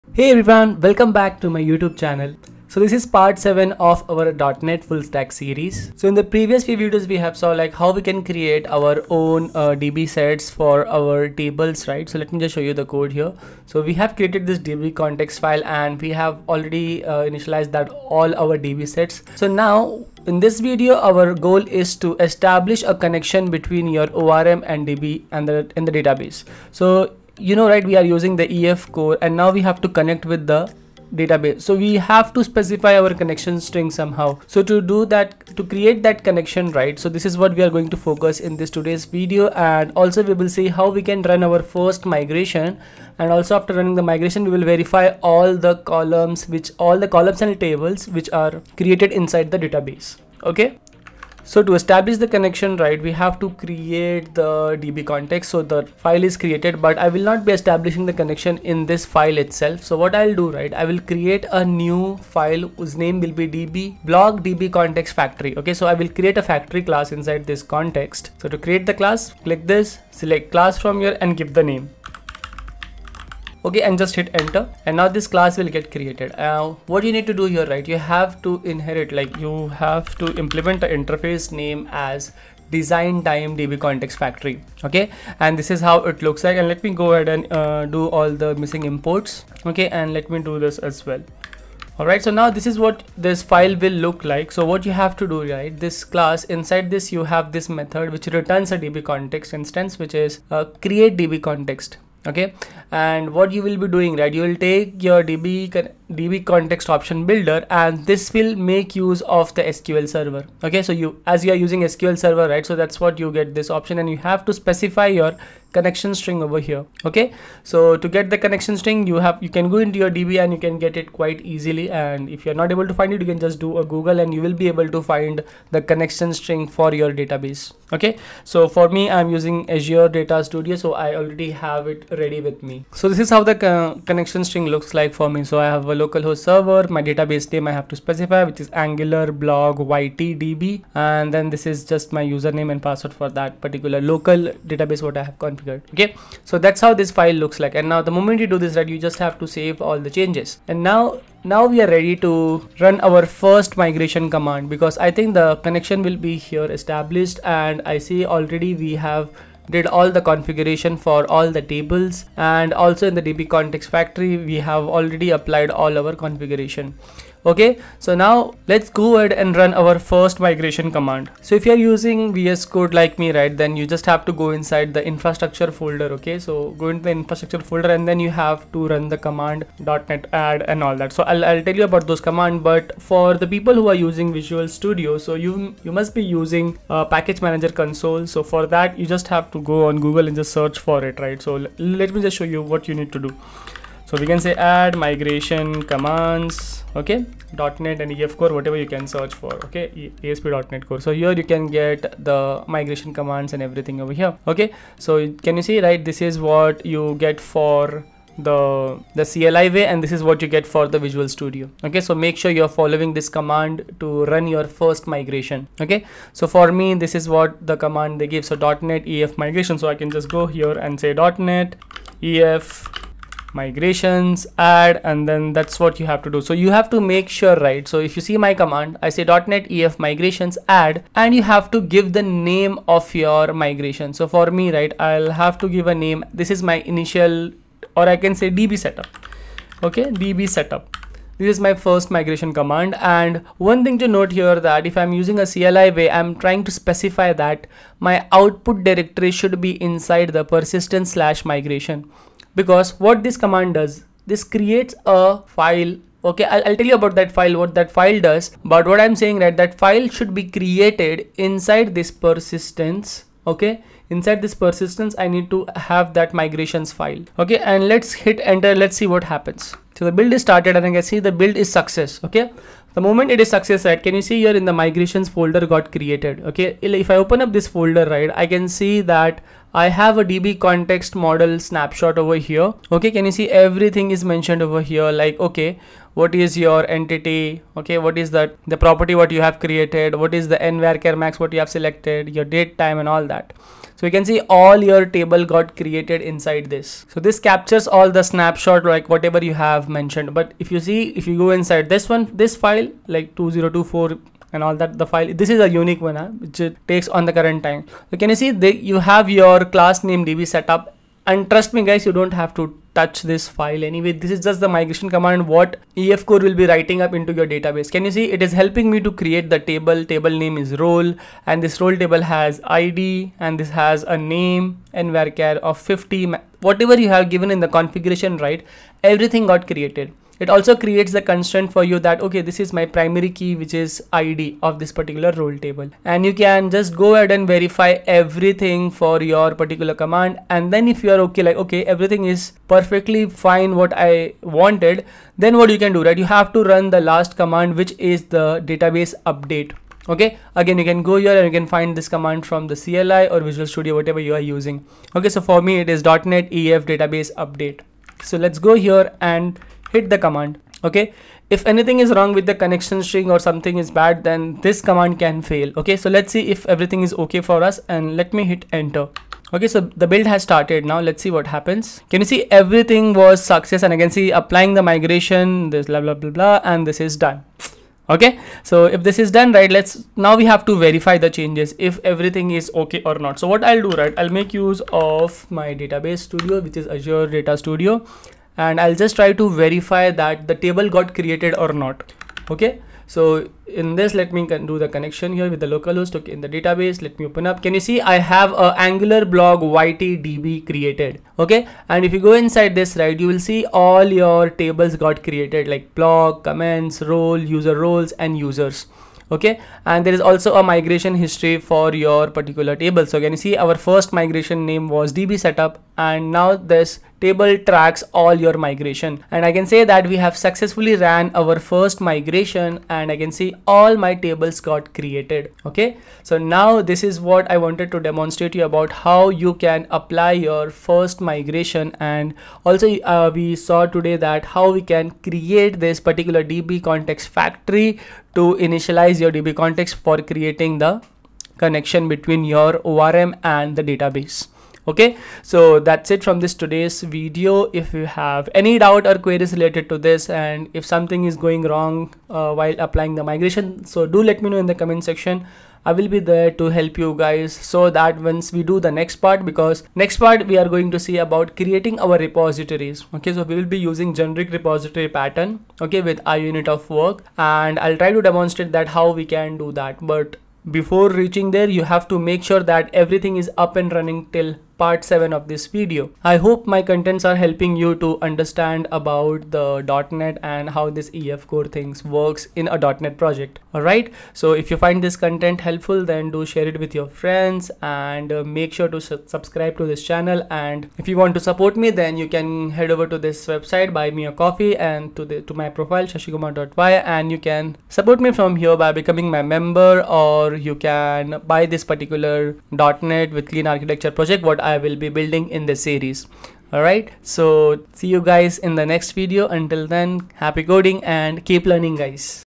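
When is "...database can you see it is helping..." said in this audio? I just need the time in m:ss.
5:17.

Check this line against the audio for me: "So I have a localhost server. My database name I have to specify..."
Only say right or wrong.
right.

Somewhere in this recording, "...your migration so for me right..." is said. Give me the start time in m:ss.
3:53.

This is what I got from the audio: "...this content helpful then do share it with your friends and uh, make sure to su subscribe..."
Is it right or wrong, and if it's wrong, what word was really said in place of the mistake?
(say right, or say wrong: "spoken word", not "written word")
right.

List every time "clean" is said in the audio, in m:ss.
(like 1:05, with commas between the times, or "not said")
8:23.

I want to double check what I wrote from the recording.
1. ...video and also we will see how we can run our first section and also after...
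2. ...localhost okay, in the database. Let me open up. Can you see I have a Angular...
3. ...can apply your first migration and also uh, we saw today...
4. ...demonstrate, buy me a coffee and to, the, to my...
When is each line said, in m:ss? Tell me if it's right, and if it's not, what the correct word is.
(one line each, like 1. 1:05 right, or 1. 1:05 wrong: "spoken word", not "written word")
1. 0:39 wrong: "migration", not "section"
2. 6:35 right
3. 7:09 right
4. 8:13 wrong: "website", not "demonstrate".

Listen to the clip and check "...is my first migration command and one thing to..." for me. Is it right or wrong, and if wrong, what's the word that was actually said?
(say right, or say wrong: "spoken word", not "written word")
right.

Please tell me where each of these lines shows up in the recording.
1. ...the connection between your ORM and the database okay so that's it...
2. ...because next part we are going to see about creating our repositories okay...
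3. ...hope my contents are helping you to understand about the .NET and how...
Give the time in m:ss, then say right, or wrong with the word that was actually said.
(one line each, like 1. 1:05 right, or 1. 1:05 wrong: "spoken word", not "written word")
1. 7:20 right
2. 7:39 right
3. 7:56 right.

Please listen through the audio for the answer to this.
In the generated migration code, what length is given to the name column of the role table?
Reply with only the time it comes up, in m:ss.
5:25.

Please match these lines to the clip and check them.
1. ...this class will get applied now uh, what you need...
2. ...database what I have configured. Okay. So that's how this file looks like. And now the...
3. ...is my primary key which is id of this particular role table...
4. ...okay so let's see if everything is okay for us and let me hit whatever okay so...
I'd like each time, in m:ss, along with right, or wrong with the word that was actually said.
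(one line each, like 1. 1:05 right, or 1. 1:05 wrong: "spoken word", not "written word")
1. 1:15 wrong: "created", not "applied"
2. 2:24 right
3. 5:32 right
4. 6:05 wrong: "enter", not "whatever".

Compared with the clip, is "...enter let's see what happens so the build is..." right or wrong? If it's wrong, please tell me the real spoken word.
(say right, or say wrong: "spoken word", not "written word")
right.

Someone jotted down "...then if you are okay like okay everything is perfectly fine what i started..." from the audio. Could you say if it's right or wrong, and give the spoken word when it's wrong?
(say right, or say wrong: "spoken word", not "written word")
wrong: "wanted", not "started".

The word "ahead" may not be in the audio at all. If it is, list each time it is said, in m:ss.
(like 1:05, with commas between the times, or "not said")
1:27, 2:49, 5:37.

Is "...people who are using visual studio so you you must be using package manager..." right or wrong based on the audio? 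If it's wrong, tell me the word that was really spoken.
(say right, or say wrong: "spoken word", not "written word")
right.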